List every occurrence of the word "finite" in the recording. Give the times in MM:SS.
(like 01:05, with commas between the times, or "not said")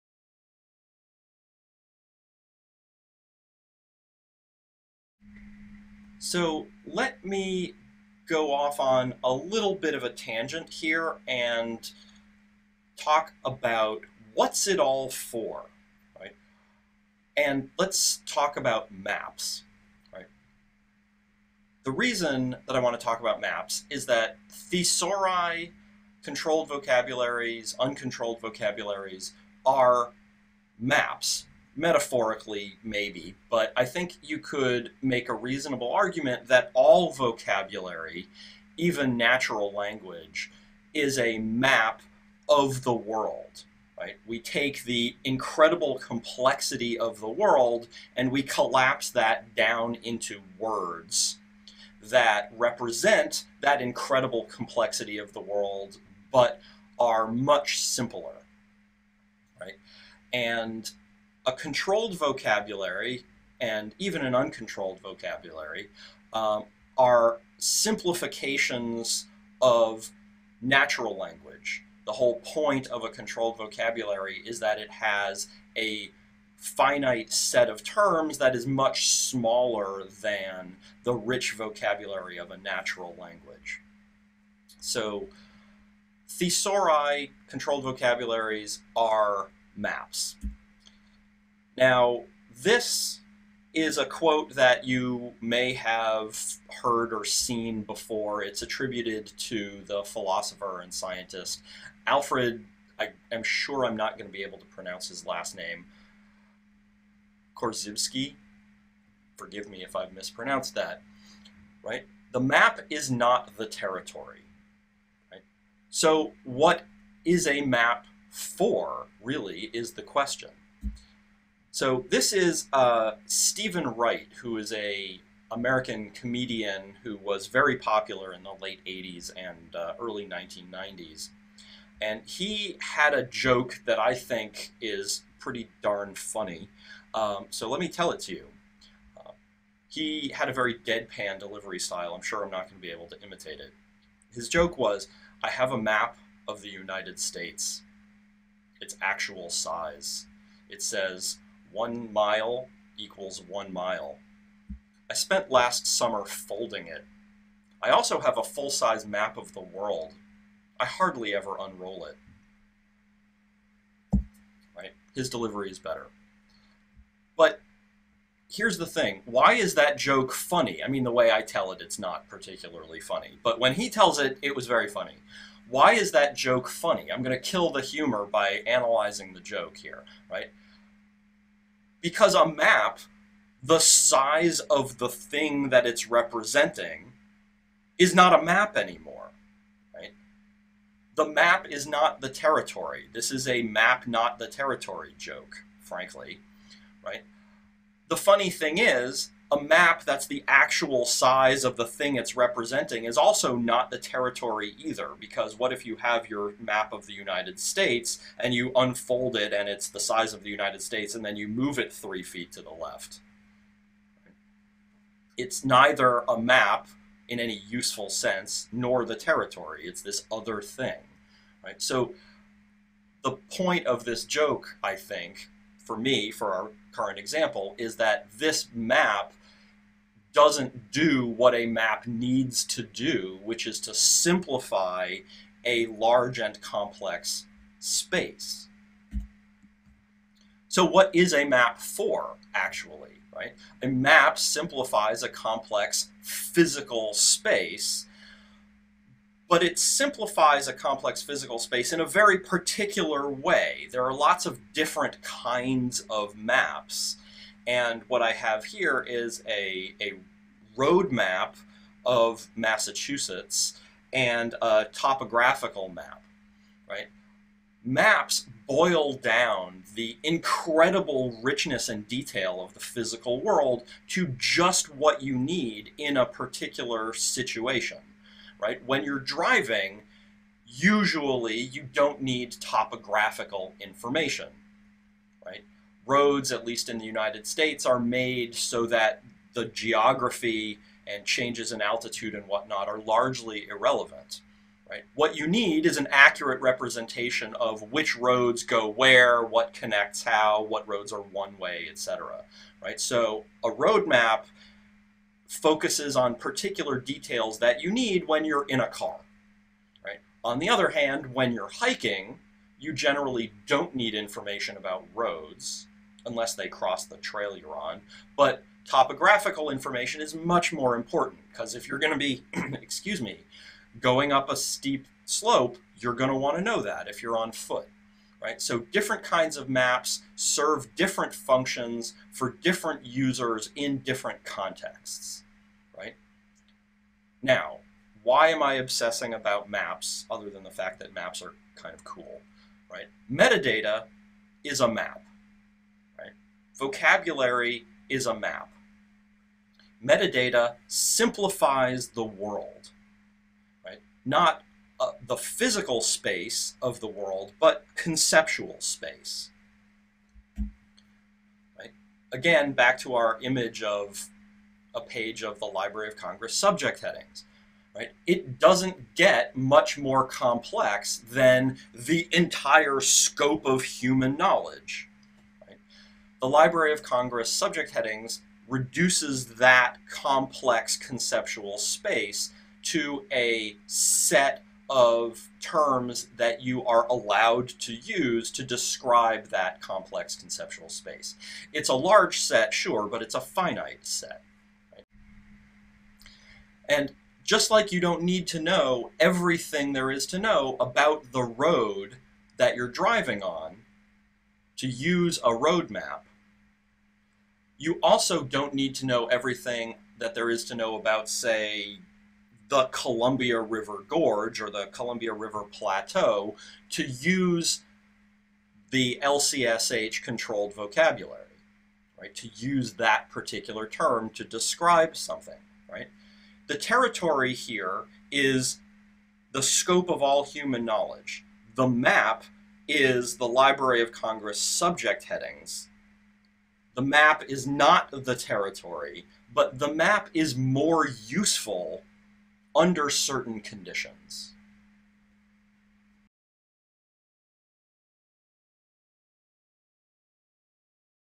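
01:16, 06:33.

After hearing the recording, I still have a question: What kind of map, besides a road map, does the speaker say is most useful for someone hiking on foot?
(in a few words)
Topographical map.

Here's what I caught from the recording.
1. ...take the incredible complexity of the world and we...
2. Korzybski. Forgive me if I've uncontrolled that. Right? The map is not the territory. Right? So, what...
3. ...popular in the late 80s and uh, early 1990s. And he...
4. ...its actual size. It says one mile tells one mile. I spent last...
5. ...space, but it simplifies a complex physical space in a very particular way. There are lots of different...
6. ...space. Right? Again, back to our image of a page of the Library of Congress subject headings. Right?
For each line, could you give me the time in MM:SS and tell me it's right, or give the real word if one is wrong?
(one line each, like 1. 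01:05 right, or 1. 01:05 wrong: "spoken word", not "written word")
1. 00:44 right
2. 01:47 wrong: "mispronounced", not "uncontrolled"
3. 02:07 right
4. 02:28 wrong: "equals", not "tells"
5. 04:07 right
6. 05:58 right.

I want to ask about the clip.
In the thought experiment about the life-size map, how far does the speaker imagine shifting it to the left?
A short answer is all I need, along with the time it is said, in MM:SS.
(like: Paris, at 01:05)
3 feet, at 03:31.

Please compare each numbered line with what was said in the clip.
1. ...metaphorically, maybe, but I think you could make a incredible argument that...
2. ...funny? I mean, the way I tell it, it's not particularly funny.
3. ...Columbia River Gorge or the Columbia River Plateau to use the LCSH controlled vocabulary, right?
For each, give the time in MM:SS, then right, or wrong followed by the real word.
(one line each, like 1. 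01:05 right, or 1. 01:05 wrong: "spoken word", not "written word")
1. 00:31 wrong: "reasonable", not "incredible"
2. 02:50 right
3. 06:52 right.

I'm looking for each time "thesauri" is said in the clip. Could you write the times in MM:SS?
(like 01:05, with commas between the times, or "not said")
00:24, 01:26.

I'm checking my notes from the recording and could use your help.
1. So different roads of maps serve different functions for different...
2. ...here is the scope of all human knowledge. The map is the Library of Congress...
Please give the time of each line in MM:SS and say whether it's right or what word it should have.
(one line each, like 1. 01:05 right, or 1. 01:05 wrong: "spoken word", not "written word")
1. 05:28 wrong: "kinds", not "roads"
2. 07:07 right.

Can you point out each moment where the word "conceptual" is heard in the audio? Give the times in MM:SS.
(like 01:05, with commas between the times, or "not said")
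05:57, 06:20, 06:30.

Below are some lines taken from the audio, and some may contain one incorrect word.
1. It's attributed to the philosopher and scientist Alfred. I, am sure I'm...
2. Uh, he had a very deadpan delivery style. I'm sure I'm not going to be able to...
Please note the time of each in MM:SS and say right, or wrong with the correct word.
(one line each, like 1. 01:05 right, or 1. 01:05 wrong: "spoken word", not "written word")
1. 01:38 right
2. 02:19 right.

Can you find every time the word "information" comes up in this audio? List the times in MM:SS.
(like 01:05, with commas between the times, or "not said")
04:43, 05:14, 05:19.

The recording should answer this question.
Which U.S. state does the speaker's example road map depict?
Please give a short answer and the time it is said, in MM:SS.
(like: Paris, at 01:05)
Massachusetts, at 04:22.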